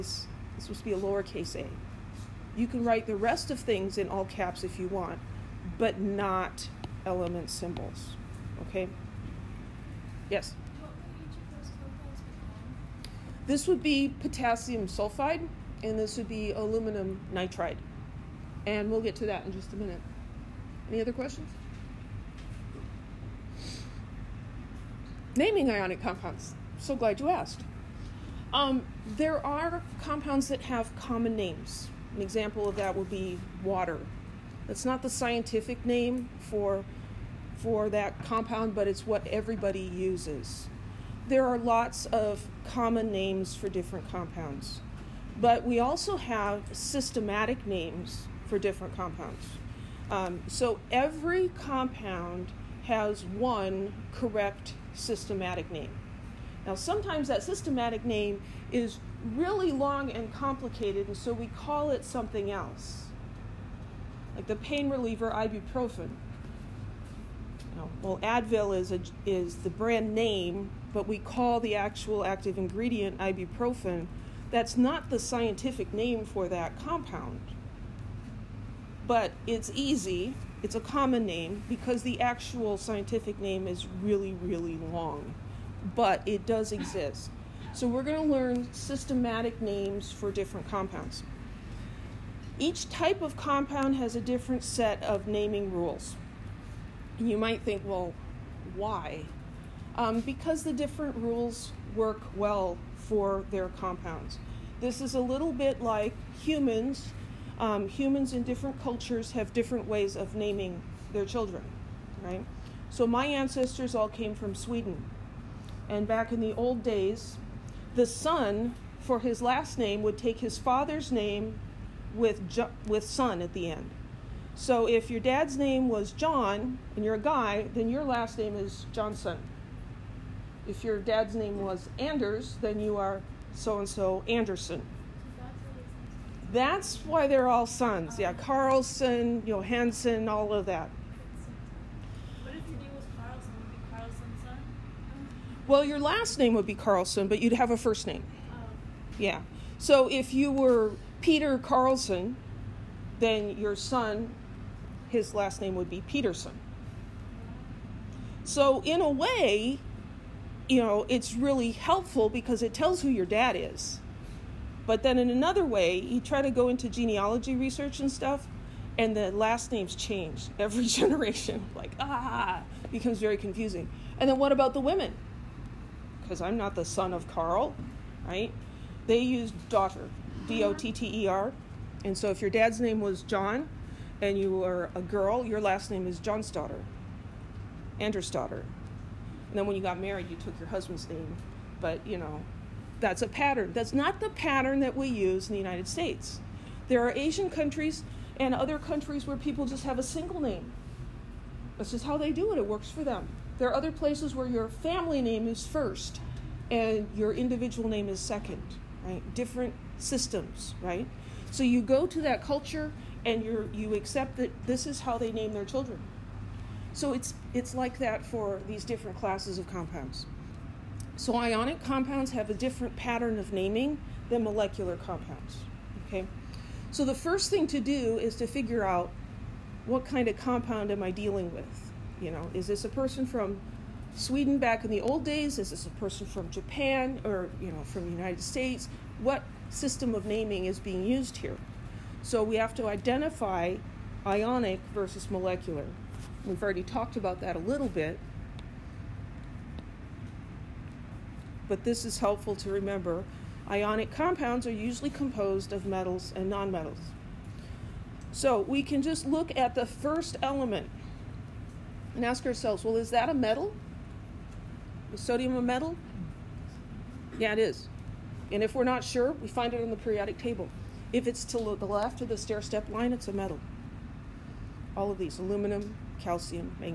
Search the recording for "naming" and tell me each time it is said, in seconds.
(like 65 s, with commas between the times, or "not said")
25 s, 95 s, 110 s, 223 s, 240 s.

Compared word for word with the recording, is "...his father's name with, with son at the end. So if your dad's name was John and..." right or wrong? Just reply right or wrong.
right.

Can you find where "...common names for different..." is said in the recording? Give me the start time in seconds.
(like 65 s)
42 s.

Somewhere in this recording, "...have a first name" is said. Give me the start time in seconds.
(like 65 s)
147 s.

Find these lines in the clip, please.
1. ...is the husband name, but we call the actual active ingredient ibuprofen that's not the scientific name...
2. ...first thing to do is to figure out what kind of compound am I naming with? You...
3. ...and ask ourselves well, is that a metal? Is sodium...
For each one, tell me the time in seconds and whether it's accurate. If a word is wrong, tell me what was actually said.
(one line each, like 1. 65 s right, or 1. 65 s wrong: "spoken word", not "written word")
1. 69 s wrong: "brand", not "husband"
2. 227 s wrong: "dealing", not "naming"
3. 262 s right.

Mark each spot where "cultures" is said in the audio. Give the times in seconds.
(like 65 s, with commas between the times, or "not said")
108 s, 212 s.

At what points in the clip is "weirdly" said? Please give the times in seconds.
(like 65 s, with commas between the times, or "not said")
not said.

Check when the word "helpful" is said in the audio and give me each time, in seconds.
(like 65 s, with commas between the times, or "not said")
161 s, 252 s.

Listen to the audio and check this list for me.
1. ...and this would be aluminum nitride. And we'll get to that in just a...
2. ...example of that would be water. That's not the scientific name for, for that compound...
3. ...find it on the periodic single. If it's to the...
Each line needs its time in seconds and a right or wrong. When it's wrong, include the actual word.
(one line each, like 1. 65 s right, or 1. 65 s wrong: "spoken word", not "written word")
1. 15 s right
2. 32 s right
3. 269 s wrong: "table", not "single".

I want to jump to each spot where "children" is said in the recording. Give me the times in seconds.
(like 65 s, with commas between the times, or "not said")
111 s, 215 s.